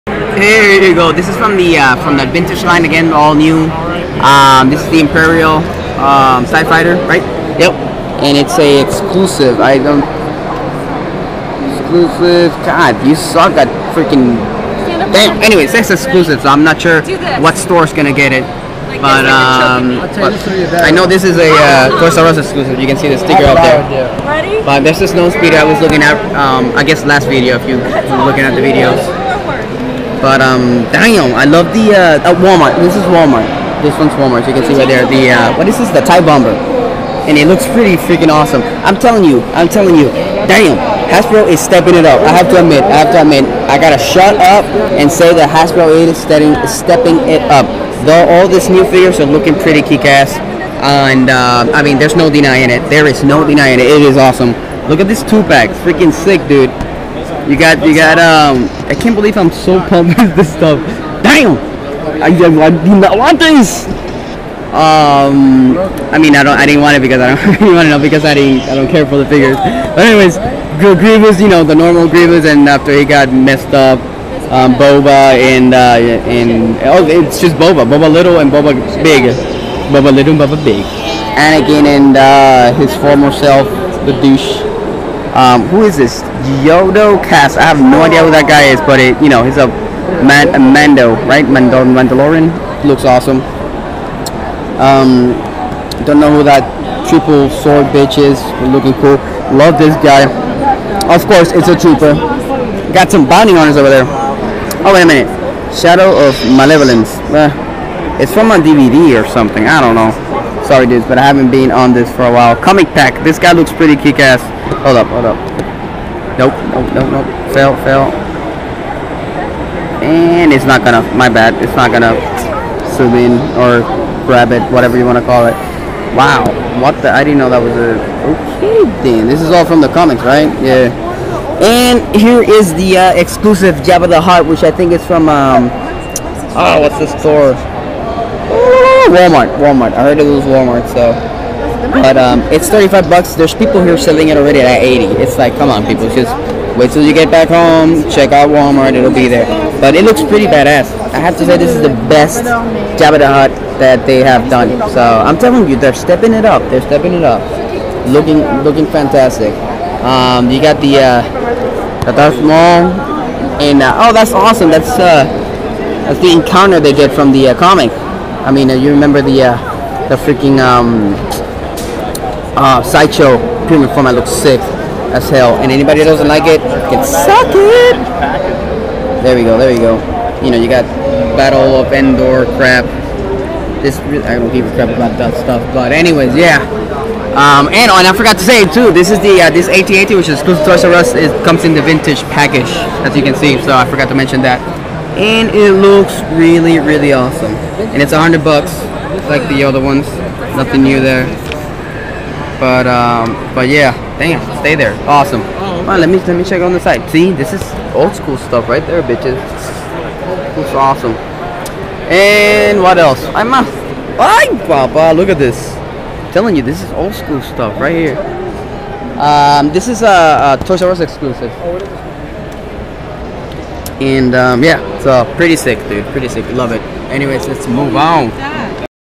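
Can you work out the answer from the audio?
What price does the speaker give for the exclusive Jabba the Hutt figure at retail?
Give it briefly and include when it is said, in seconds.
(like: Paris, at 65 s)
$35, at 142 s.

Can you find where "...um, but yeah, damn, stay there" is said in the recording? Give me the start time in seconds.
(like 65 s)
202 s.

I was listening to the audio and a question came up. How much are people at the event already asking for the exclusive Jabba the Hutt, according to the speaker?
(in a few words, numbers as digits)
80.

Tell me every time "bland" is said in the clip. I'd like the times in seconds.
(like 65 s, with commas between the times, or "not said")
not said.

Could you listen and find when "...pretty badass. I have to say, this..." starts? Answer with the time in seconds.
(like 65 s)
150 s.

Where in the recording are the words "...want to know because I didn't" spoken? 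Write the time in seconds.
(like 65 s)
67 s.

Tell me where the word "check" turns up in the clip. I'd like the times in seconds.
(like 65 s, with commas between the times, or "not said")
148 s, 206 s.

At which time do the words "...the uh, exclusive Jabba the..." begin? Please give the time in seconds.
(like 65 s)
132 s.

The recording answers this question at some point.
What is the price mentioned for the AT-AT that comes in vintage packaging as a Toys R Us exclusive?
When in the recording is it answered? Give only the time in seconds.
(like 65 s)
198 s.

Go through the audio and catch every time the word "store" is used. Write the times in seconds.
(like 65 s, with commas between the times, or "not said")
17 s, 137 s.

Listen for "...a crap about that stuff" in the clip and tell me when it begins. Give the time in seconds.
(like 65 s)
184 s.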